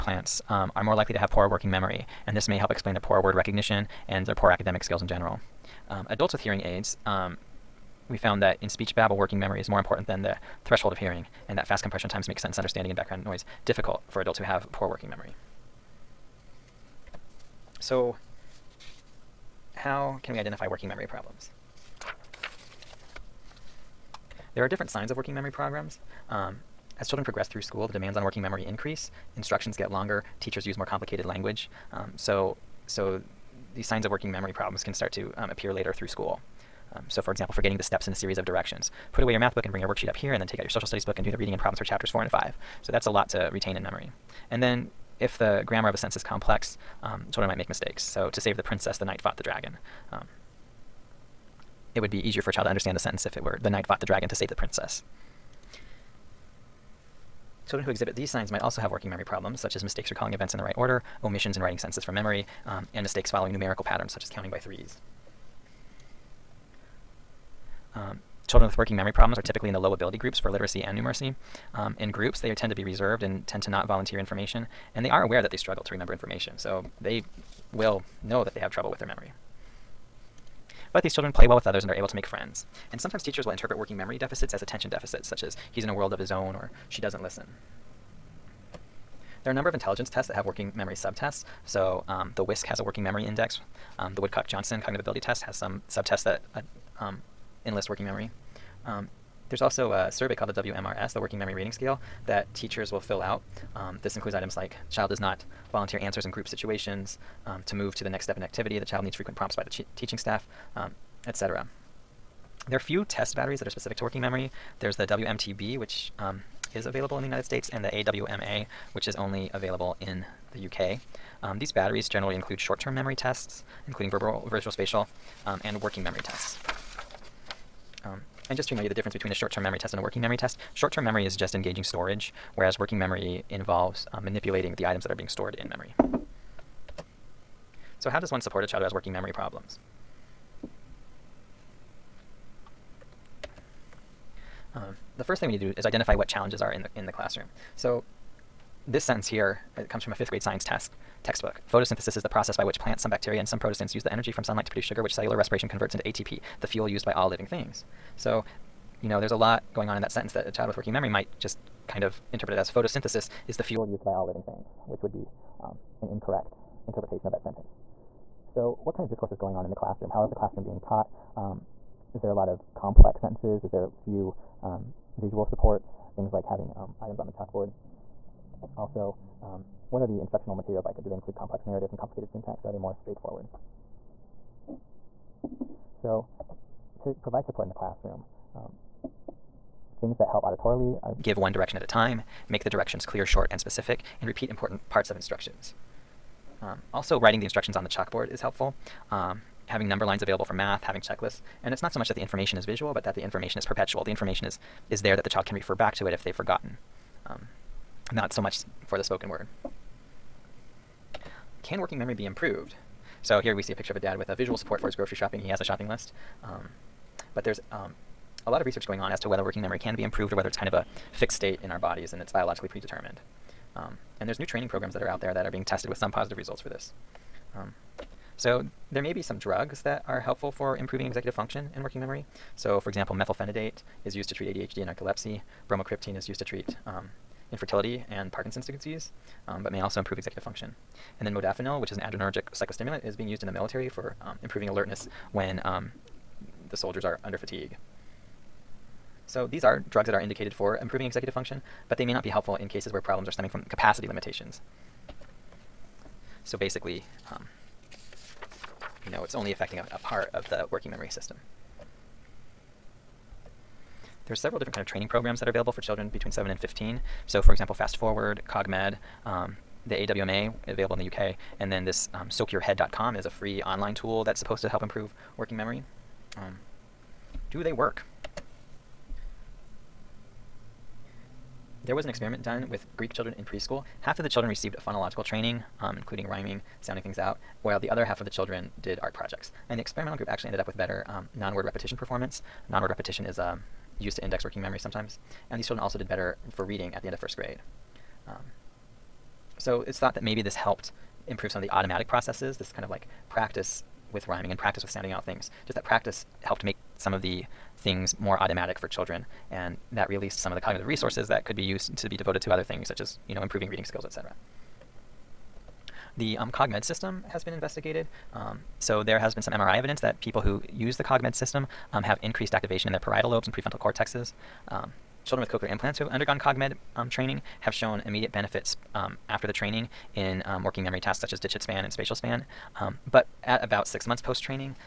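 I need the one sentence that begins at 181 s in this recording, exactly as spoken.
Do they include complex narratives and complicated syntax, or are they more straightforward?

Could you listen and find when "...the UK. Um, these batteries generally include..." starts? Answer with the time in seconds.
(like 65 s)
120 s.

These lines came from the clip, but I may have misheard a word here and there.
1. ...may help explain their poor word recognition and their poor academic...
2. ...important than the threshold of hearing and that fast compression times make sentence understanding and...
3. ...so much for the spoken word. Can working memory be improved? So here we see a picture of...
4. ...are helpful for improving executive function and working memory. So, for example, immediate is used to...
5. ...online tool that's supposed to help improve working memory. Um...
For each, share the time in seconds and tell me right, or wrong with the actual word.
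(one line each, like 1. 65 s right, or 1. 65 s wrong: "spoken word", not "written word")
1. 2 s right
2. 9 s right
3. 208 s right
4. 230 s wrong: "methylphenidate", not "immediate"
5. 273 s right.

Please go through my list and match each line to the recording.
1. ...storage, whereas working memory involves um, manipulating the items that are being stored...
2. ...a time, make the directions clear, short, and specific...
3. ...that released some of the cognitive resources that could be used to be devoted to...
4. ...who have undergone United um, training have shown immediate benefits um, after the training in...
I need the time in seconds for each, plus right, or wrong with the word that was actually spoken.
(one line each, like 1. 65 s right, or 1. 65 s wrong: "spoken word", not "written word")
1. 131 s right
2. 191 s right
3. 309 s right
4. 325 s wrong: "CogMed", not "United".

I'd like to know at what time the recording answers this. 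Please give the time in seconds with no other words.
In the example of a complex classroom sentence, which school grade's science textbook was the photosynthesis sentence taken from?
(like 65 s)
150 s.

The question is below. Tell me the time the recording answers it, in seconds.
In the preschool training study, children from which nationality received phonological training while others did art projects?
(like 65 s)
282 s.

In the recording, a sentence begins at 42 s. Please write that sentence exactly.
So that's a lot to retain in memory.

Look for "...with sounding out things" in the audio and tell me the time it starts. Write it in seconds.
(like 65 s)
304 s.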